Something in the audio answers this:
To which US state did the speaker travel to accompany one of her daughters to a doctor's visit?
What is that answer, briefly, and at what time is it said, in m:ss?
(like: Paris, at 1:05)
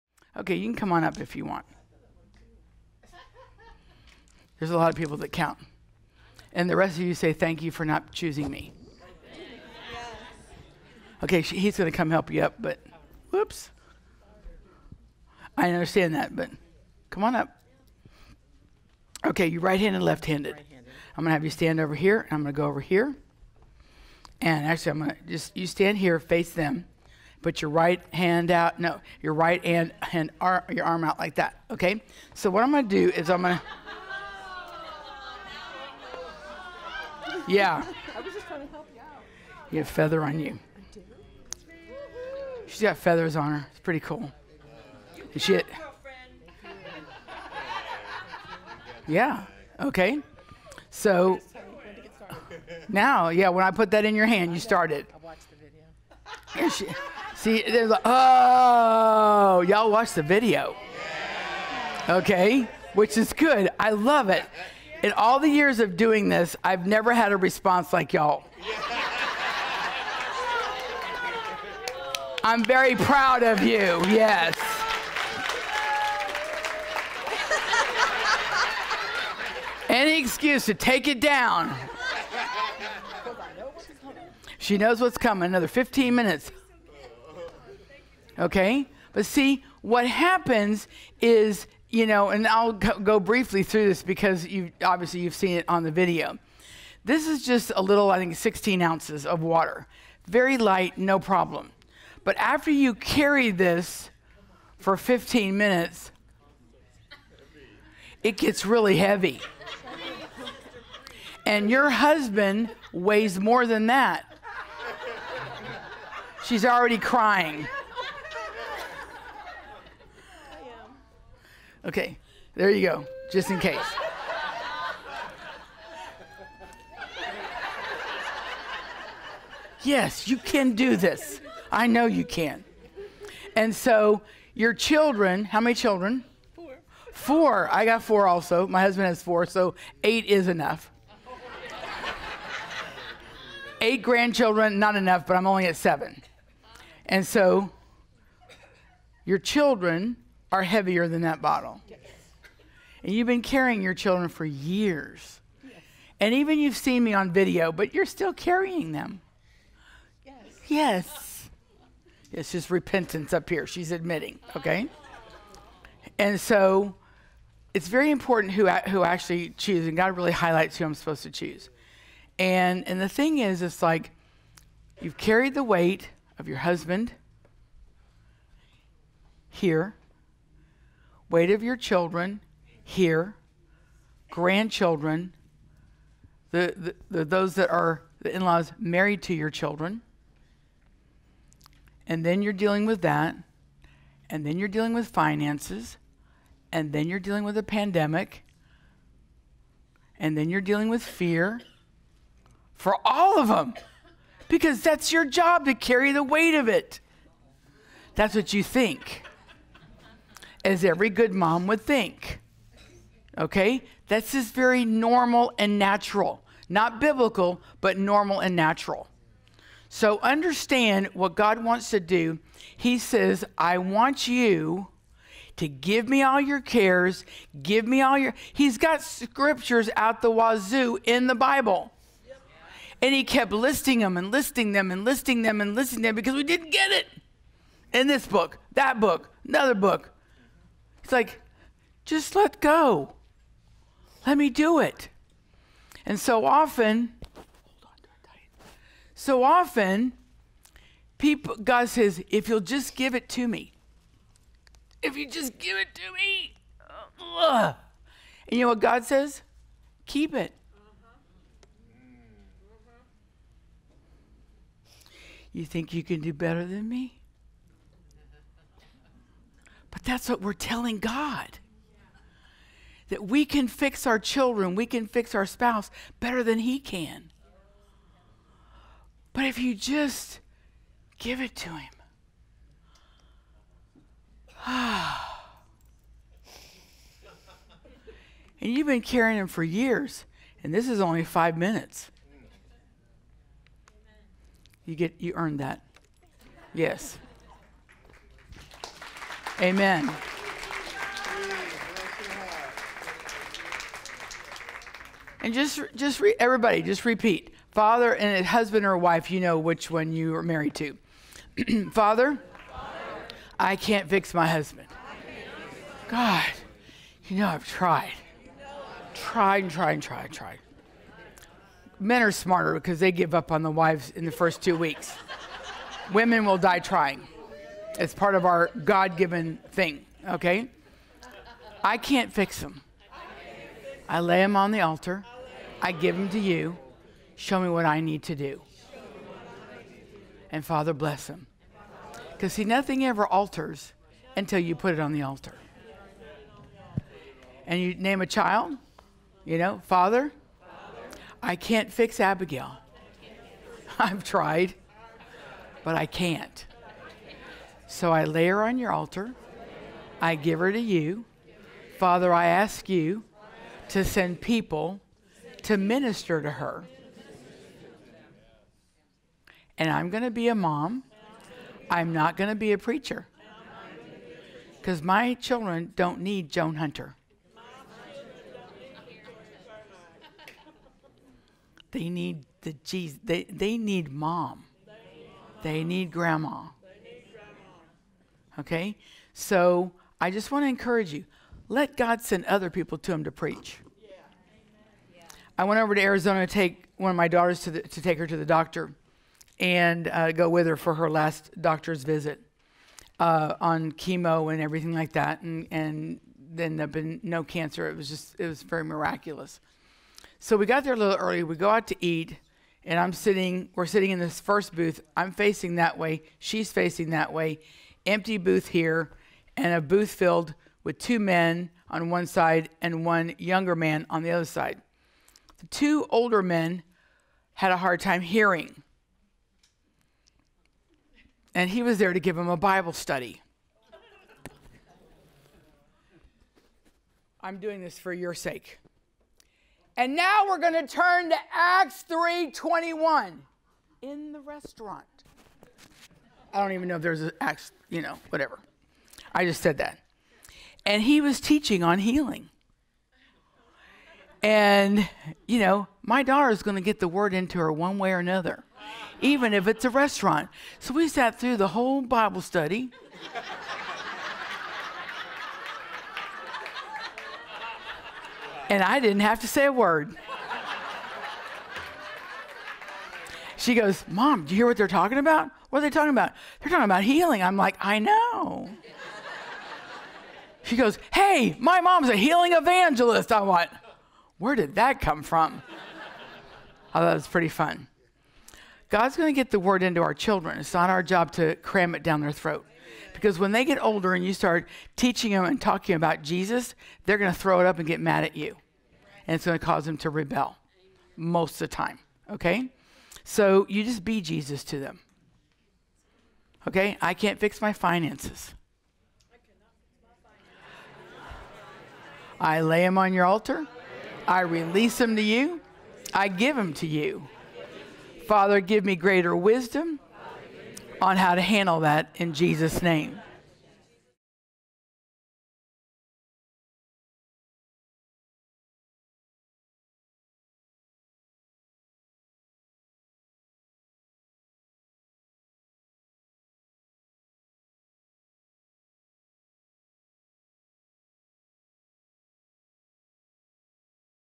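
Arizona, at 6:36.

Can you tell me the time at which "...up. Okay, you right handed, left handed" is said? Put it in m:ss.
0:17.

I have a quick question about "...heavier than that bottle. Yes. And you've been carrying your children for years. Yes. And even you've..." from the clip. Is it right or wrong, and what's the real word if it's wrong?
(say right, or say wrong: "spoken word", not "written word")
right.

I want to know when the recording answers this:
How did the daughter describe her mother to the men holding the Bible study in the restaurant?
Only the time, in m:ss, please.
8:02.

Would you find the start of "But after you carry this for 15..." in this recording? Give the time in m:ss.
1:42.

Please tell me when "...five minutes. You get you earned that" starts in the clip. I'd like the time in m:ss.
4:51.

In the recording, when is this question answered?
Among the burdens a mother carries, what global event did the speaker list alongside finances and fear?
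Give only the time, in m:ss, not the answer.
3:17.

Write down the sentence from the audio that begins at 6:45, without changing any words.
And, and then there been no cancer.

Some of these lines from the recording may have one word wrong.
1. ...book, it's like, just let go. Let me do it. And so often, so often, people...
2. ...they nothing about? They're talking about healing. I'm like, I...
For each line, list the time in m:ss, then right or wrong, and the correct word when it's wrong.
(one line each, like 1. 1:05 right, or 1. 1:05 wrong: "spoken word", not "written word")
1. 3:59 right
2. 7:55 wrong: "talking", not "nothing".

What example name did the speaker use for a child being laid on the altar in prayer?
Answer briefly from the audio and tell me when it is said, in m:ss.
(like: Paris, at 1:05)
Abigail, at 5:52.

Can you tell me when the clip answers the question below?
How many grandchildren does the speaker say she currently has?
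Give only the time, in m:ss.
2:25.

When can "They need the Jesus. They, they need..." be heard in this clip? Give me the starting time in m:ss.
6:21.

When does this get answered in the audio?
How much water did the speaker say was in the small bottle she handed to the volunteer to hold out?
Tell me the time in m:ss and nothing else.
1:38.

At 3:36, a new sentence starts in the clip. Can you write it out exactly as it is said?
Not biblical, but normal and natural.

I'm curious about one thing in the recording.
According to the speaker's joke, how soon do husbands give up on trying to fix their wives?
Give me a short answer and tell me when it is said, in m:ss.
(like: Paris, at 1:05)
In the first two weeks, at 5:24.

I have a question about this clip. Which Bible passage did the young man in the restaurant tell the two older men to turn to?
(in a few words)
Acts 3:21.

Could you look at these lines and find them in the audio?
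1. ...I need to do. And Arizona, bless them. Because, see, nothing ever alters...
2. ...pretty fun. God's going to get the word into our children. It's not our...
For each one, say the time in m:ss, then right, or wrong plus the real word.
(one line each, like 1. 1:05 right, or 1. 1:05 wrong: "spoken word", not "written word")
1. 5:37 wrong: "Father", not "Arizona"
2. 8:07 right.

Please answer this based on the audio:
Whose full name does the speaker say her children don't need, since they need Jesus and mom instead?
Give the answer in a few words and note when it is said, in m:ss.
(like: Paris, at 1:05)
Joan Hunter, at 6:16.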